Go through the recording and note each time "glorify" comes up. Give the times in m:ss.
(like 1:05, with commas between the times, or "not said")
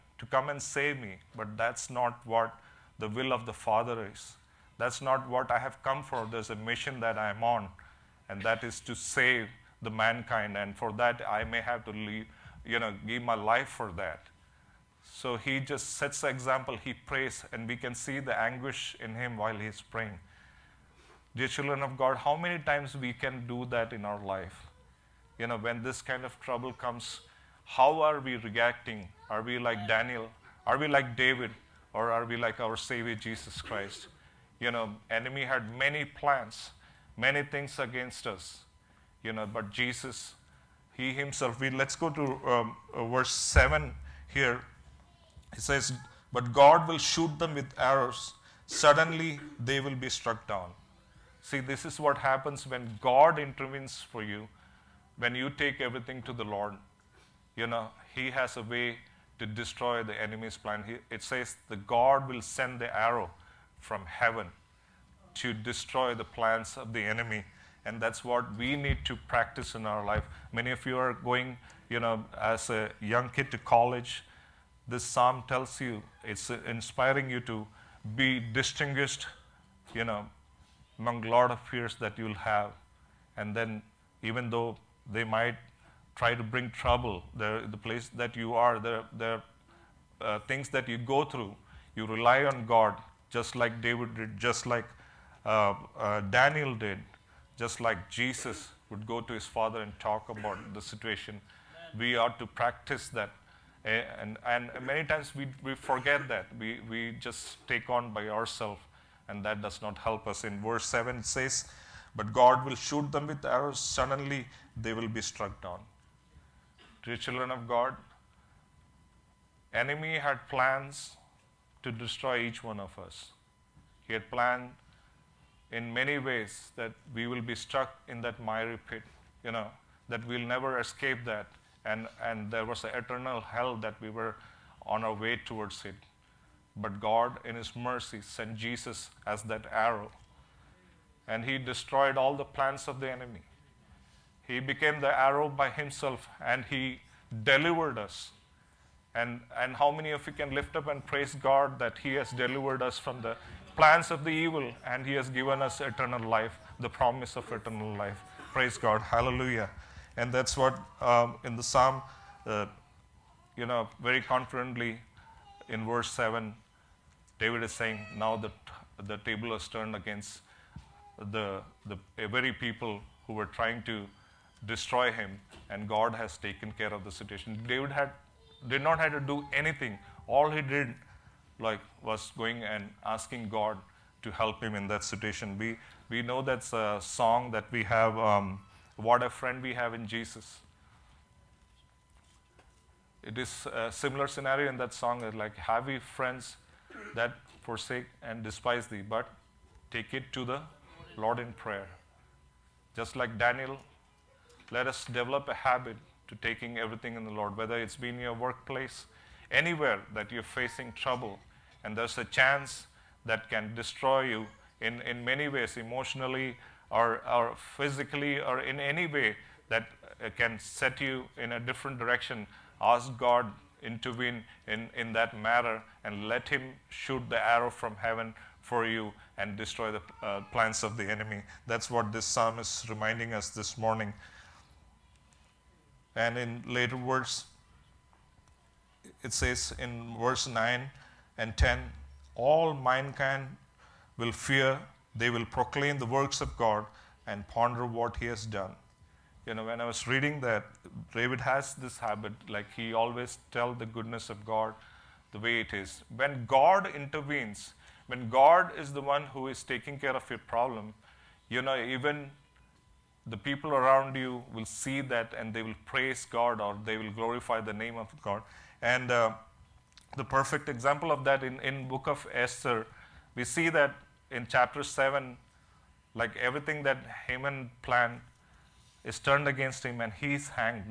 4:27.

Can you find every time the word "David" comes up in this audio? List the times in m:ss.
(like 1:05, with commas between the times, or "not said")
0:31, 1:33, 2:47, 2:57, 4:11.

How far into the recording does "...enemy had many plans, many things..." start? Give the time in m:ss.
0:35.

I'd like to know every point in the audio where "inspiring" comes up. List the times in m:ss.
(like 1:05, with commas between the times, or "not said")
1:16.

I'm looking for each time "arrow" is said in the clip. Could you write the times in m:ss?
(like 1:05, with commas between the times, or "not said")
0:47, 1:02, 1:53, 2:19, 2:25, 3:47.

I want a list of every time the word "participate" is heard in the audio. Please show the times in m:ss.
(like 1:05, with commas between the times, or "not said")
not said.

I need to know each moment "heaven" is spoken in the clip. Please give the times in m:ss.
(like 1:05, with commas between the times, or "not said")
1:04, 3:47.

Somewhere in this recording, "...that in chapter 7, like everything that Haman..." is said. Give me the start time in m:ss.
4:33.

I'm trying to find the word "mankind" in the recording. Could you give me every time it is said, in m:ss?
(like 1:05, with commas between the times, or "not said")
0:09, 4:02.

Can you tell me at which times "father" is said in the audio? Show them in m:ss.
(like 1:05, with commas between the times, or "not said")
0:03, 1:39.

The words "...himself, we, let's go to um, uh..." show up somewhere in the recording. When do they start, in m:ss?
0:41.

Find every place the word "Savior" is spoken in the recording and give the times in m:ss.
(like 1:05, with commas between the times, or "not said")
0:32.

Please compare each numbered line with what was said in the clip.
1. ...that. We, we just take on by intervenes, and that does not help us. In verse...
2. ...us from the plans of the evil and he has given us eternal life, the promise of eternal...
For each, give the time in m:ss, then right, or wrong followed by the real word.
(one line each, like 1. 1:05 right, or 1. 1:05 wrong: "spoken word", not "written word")
1. 1:46 wrong: "ourselves", not "intervenes"
2. 2:32 right.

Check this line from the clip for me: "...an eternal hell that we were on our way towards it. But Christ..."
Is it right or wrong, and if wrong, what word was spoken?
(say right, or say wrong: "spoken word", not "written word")
wrong: "God", not "Christ".